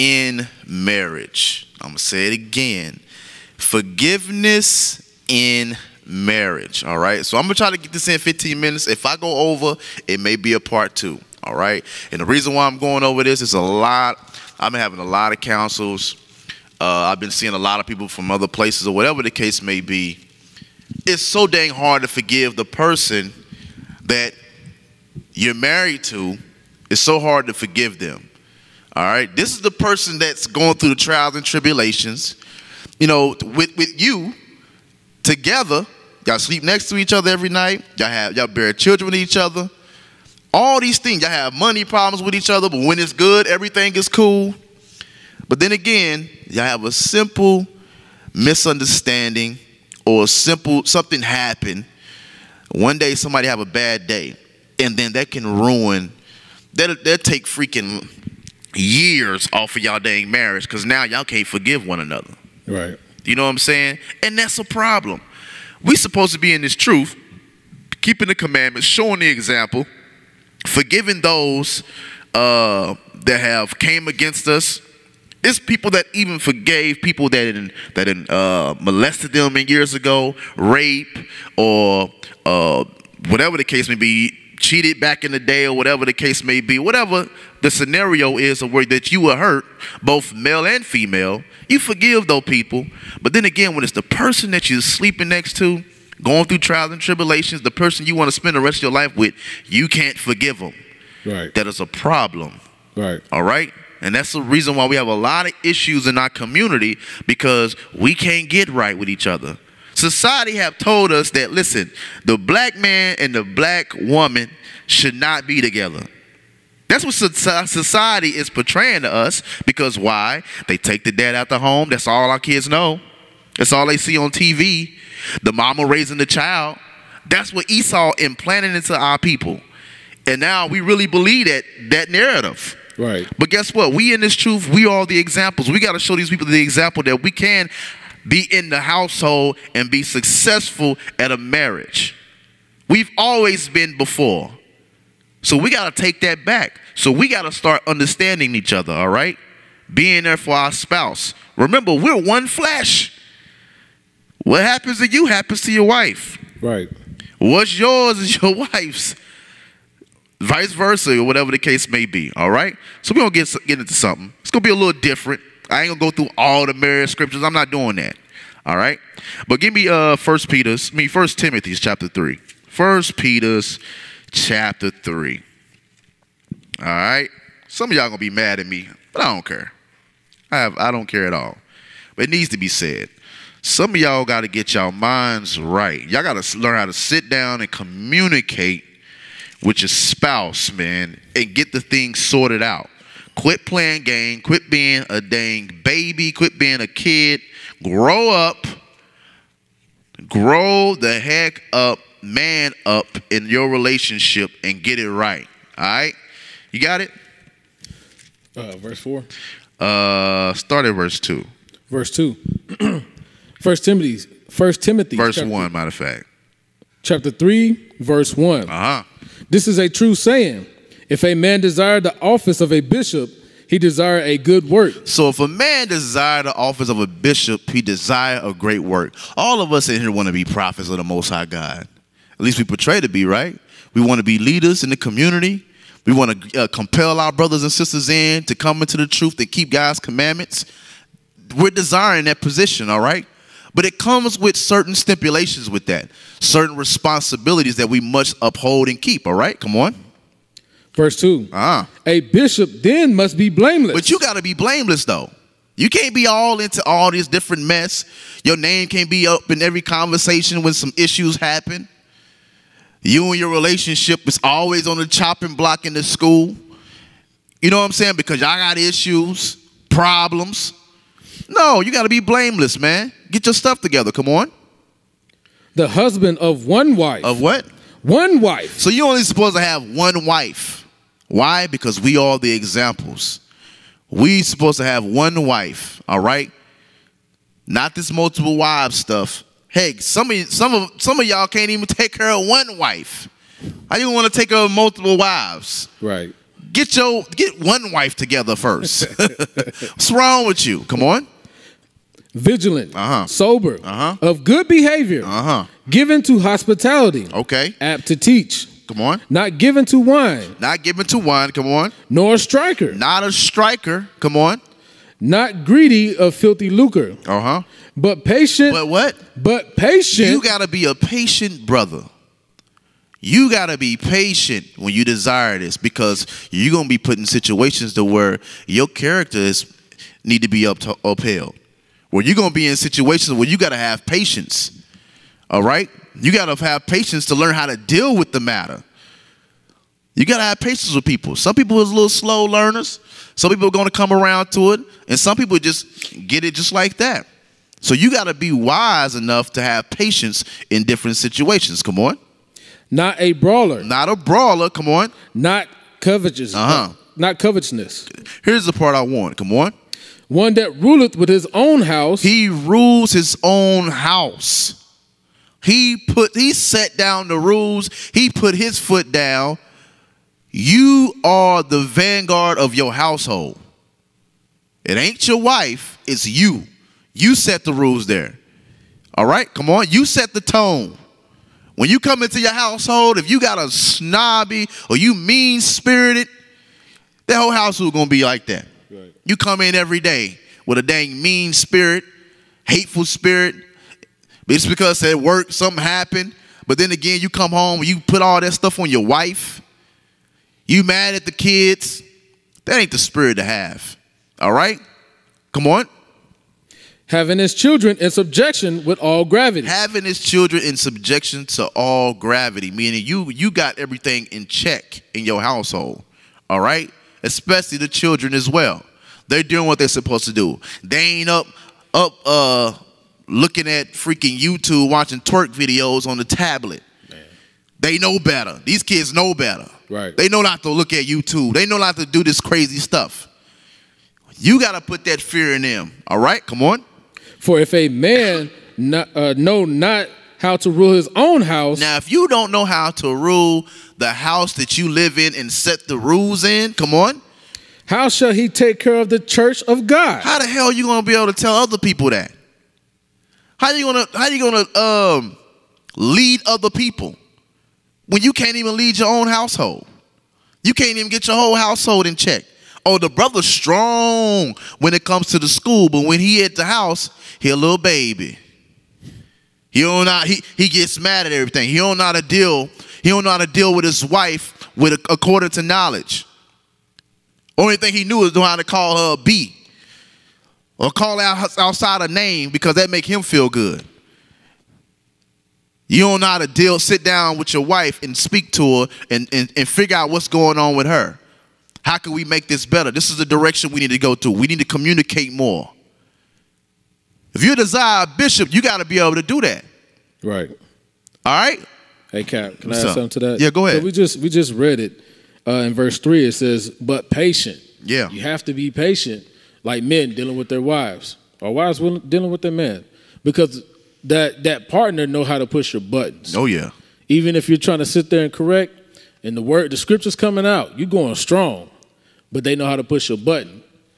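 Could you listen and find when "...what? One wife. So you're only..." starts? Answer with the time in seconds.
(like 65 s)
277 s.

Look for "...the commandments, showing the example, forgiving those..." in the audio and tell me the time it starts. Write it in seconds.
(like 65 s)
68 s.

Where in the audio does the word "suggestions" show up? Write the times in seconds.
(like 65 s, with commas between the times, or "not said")
not said.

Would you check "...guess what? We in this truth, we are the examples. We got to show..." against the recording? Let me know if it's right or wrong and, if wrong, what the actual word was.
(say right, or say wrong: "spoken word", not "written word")
right.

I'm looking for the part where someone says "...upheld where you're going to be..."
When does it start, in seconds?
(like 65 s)
331 s.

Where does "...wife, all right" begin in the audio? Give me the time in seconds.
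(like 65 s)
285 s.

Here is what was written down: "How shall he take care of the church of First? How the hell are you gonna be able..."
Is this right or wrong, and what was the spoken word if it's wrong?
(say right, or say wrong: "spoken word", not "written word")
wrong: "God", not "First".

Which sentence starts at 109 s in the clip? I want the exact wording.
Society have told us that, listen, the black man and the black woman should not be together.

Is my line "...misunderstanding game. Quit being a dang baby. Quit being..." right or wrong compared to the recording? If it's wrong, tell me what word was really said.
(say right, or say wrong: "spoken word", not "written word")
wrong: "playing", not "misunderstanding".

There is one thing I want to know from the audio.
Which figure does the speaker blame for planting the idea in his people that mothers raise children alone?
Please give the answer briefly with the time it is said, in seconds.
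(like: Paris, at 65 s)
Esau, at 127 s.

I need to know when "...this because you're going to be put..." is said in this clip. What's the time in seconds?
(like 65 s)
325 s.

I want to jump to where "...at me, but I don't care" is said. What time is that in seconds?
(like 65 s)
178 s.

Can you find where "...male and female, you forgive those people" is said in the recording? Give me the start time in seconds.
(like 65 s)
90 s.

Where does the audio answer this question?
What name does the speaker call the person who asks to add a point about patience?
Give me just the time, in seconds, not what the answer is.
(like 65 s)
502 s.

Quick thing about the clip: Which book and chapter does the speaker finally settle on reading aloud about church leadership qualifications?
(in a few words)
1 Timothy chapter 3.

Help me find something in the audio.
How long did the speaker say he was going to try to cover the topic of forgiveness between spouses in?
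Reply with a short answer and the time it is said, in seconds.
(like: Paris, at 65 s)
15 minutes, at 8 s.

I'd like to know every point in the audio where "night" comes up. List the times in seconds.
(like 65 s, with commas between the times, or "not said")
37 s.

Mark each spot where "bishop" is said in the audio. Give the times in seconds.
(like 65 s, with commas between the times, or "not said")
222 s, 227 s, 252 s, 498 s.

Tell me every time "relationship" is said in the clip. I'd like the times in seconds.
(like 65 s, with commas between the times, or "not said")
203 s, 263 s.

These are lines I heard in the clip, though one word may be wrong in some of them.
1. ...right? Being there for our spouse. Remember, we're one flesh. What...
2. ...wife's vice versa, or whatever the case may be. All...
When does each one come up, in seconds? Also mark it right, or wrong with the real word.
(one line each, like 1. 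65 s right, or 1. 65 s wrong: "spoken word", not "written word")
1. 149 s right
2. 158 s right.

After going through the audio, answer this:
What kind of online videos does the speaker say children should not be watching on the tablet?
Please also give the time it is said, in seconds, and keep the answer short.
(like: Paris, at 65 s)
Twerk videos, at 425 s.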